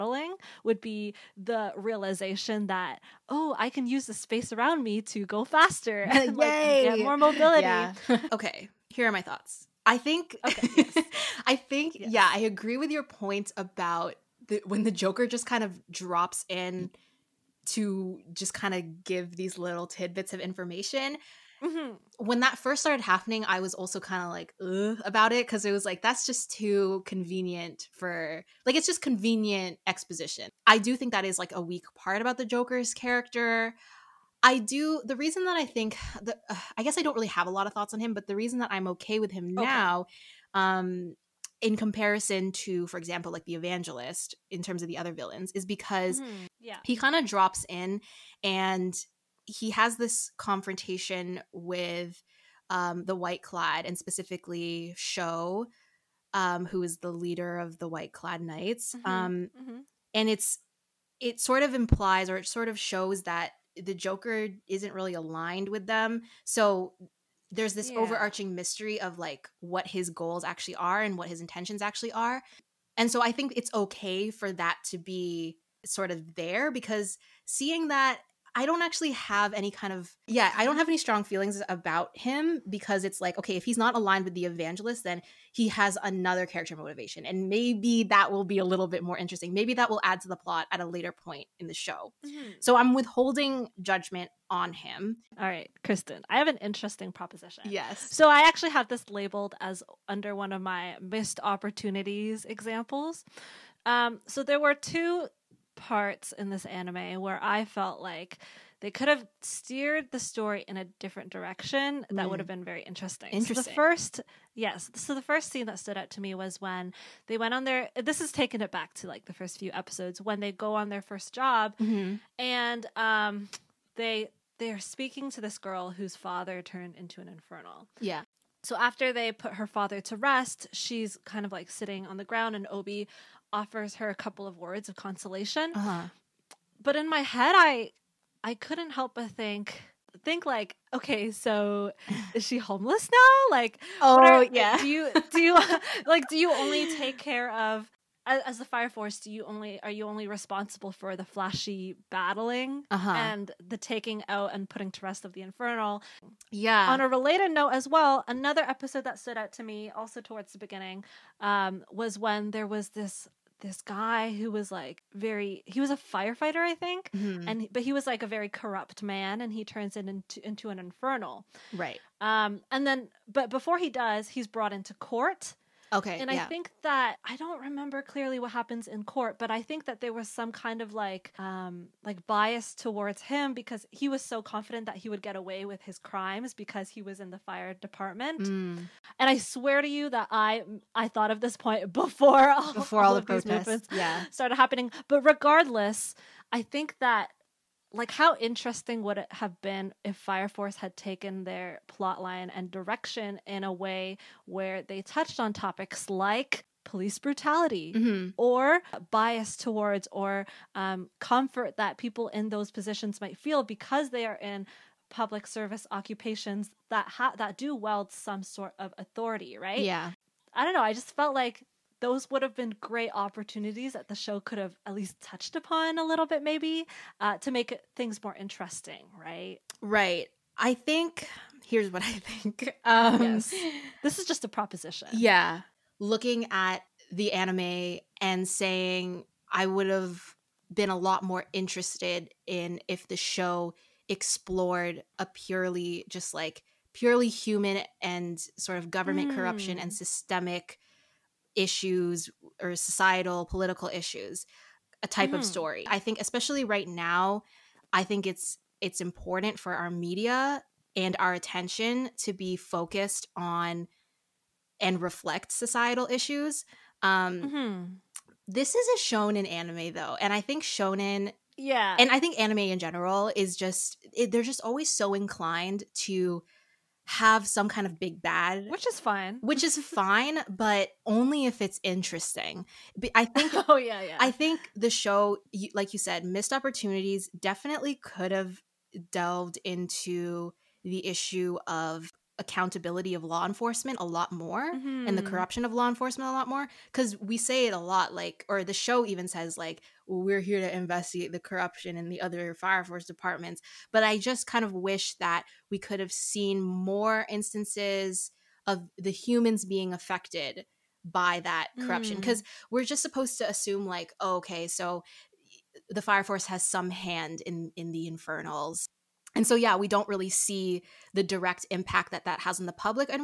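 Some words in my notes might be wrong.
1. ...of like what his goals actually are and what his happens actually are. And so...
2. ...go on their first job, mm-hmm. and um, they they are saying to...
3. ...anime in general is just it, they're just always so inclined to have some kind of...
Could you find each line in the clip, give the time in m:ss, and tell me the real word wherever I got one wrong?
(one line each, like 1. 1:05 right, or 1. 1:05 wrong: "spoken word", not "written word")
1. 1:08 wrong: "intentions", not "happens"
2. 2:00 wrong: "speaking", not "saying"
3. 4:32 right.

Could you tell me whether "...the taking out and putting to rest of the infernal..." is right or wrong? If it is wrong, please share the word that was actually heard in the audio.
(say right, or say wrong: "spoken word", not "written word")
right.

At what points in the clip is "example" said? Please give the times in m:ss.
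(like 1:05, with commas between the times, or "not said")
0:42, 1:42.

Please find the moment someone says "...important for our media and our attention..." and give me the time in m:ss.
4:18.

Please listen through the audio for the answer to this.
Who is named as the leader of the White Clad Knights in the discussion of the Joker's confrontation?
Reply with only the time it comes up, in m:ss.
0:54.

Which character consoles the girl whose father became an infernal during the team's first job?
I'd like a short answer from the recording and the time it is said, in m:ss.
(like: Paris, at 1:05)
Obi, at 2:12.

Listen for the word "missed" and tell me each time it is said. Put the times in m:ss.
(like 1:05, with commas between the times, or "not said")
1:41, 4:46.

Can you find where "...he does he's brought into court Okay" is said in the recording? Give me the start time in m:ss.
2:53.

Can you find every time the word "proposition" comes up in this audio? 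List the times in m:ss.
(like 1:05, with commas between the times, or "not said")
1:37, 3:54.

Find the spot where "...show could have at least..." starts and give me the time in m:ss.
3:44.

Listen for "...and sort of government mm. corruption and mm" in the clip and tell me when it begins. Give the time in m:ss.
4:08.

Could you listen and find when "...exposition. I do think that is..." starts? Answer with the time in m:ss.
0:29.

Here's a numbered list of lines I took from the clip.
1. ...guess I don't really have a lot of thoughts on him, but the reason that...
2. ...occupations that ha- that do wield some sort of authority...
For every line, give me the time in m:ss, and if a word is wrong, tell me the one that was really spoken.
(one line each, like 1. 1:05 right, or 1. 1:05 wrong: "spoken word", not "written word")
1. 0:36 right
2. 3:35 right.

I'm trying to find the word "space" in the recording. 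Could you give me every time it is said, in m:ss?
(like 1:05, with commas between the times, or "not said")
0:04.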